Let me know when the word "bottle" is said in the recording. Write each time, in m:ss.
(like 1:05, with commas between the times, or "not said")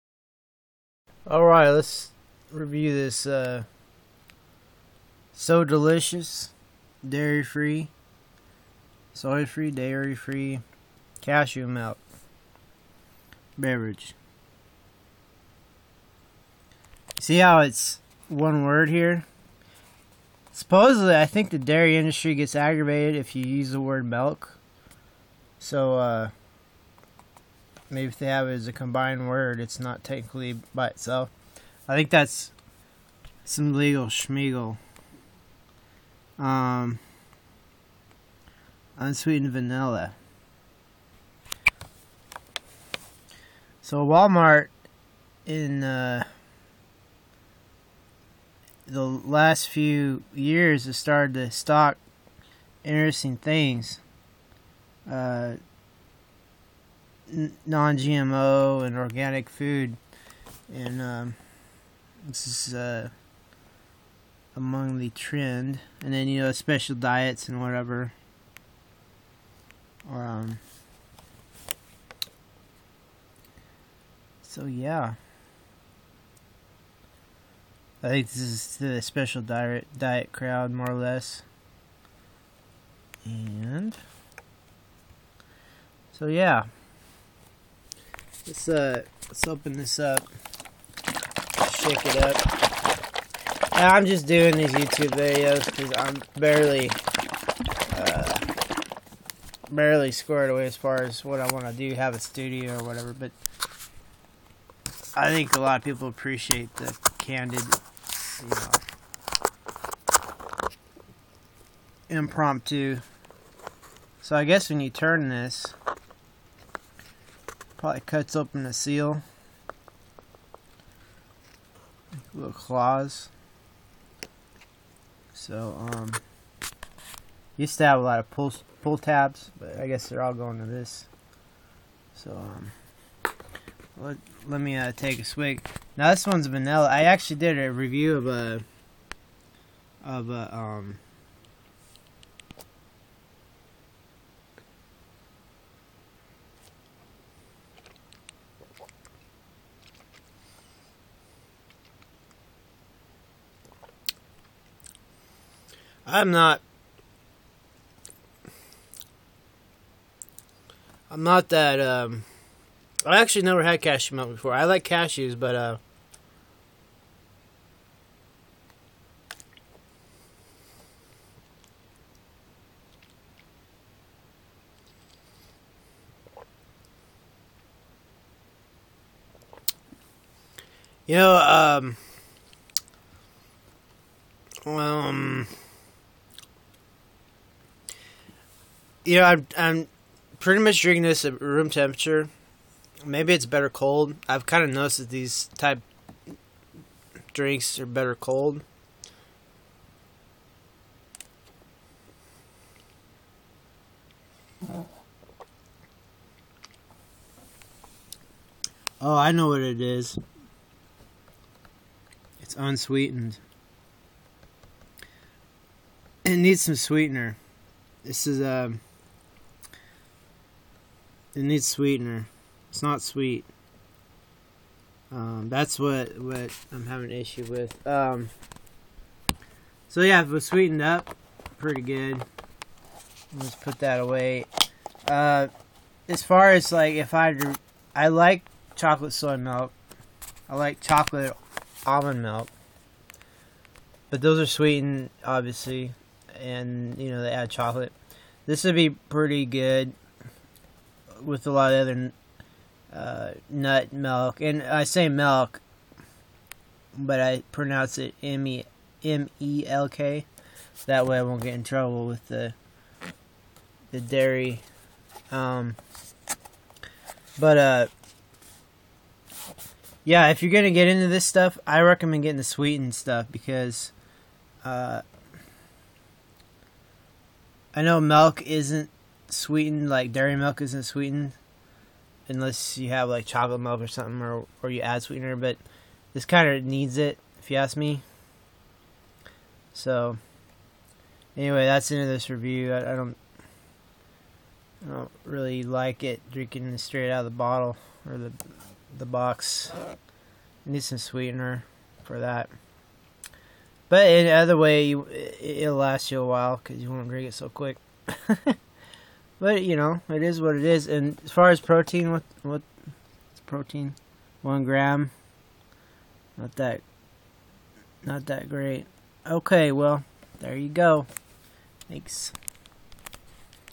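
4:57.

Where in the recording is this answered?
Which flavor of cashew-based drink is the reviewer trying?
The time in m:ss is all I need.
0:38.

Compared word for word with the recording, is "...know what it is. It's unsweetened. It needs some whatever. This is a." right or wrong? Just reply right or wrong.
wrong.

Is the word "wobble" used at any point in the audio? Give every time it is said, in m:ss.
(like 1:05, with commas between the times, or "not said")
not said.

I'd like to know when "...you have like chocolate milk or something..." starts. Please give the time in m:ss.
4:42.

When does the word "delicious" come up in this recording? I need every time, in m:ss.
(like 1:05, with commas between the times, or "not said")
0:05.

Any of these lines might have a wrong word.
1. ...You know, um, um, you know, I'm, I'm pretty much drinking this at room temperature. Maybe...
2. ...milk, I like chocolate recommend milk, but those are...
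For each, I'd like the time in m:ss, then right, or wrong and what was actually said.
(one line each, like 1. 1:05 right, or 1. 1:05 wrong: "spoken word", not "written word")
1. 3:01 right
2. 3:59 wrong: "almond", not "recommend".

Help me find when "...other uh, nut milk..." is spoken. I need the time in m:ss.
4:11.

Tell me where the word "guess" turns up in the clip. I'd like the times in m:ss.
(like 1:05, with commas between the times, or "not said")
1:54, 2:09.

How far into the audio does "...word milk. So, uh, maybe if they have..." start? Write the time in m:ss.
0:23.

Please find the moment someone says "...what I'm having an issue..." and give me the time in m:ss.
3:46.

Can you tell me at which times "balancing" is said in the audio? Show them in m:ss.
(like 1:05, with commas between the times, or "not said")
not said.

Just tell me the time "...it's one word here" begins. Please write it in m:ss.
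0:17.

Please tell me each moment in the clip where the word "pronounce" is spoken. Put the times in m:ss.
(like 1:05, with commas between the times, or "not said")
4:17.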